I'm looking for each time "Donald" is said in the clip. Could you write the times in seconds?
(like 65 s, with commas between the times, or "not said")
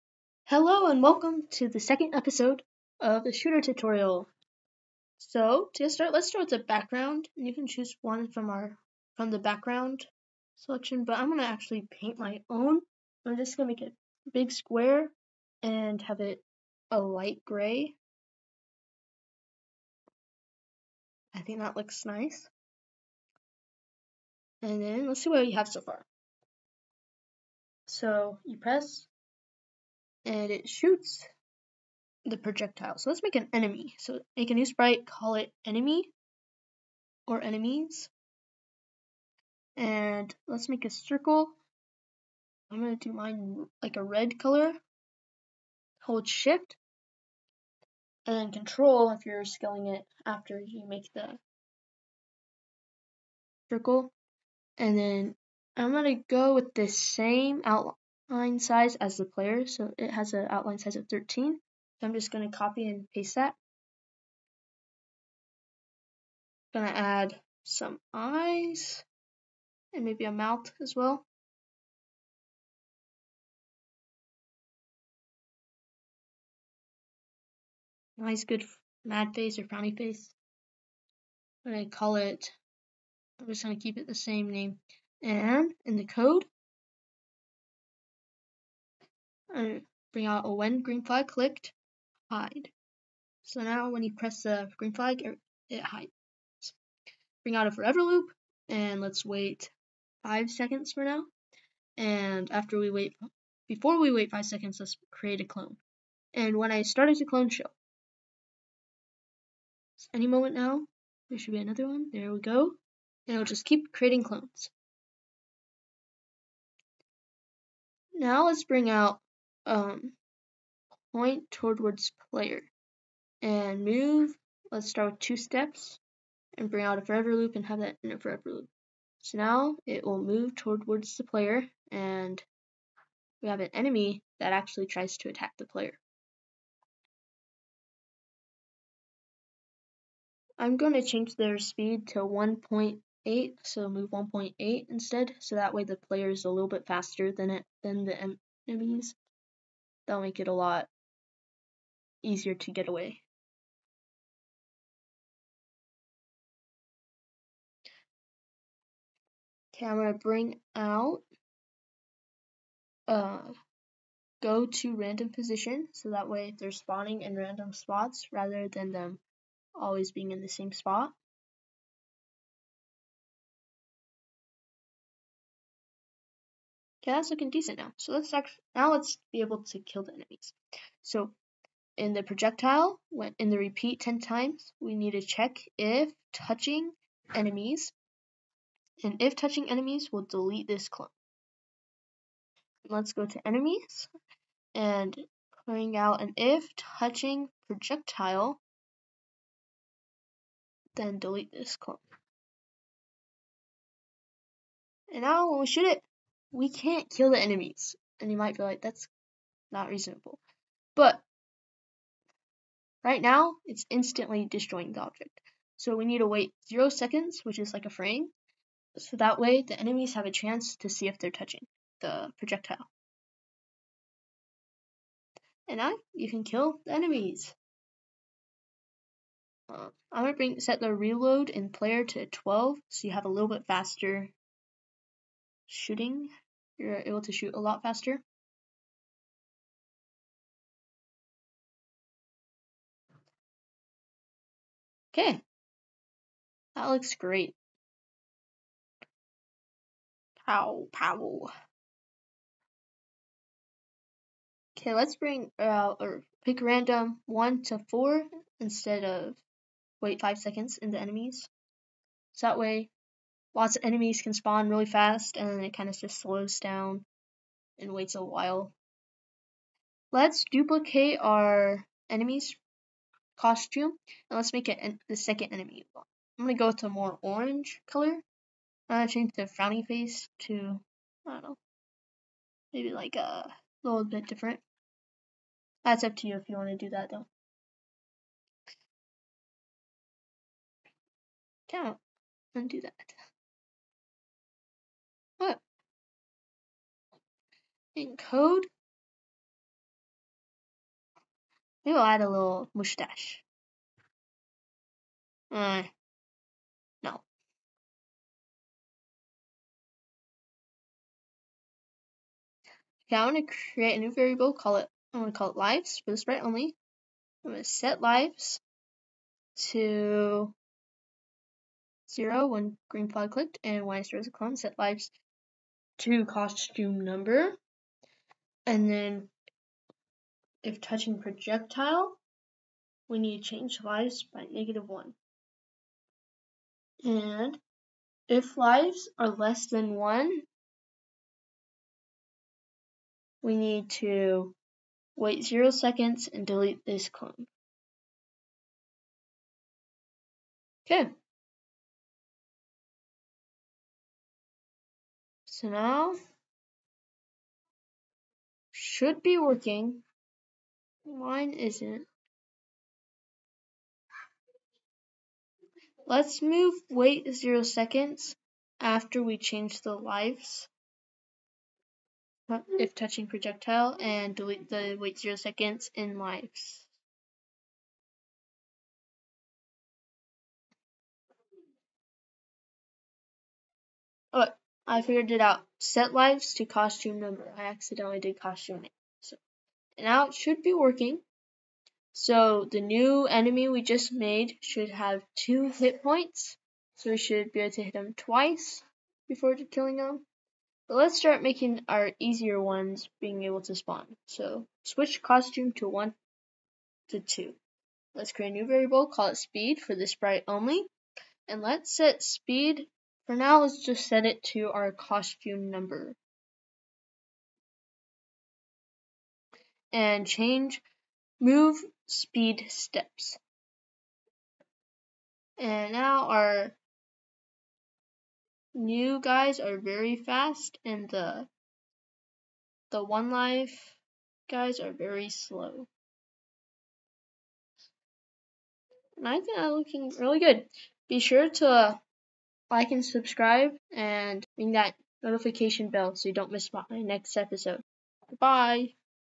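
not said.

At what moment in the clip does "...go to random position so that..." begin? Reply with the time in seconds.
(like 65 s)
164 s.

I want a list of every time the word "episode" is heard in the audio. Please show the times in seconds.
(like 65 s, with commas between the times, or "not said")
2 s, 447 s.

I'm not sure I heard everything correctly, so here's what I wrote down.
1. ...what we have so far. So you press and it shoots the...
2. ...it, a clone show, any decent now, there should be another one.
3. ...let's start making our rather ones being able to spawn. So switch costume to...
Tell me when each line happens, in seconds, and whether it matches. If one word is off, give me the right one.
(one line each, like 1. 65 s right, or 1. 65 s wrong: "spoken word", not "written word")
1. 25 s right
2. 107 s wrong: "moment", not "decent"
3. 400 s wrong: "easier", not "rather".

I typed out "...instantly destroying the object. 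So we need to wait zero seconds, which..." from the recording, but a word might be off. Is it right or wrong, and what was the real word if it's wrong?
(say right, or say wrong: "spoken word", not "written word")
right.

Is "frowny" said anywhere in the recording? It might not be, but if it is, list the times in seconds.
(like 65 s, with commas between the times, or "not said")
79 s, 279 s.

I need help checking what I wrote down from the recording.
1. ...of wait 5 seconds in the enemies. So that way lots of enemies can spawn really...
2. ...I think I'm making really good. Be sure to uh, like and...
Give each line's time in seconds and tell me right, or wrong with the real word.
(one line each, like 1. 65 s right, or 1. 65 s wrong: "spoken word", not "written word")
1. 259 s right
2. 439 s wrong: "looking", not "making".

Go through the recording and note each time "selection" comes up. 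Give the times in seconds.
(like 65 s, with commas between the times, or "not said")
10 s.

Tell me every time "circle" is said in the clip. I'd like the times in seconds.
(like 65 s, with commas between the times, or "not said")
40 s, 53 s.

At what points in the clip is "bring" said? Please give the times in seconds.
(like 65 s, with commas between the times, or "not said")
90 s, 97 s, 118 s, 126 s, 160 s, 195 s, 230 s, 255 s.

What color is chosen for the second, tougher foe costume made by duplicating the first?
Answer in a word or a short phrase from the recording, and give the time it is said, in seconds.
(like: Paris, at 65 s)
orange, at 277 s.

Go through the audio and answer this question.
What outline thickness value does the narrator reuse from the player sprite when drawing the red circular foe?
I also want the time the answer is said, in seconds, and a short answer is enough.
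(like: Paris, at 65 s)
13, at 61 s.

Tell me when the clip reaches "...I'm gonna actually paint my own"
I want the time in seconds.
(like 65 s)
11 s.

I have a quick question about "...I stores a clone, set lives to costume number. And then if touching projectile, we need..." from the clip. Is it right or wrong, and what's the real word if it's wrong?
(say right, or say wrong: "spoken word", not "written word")
right.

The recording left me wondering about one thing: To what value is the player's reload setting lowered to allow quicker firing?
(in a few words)
12.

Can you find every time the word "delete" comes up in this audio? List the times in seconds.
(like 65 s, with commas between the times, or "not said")
190 s, 201 s, 346 s, 374 s.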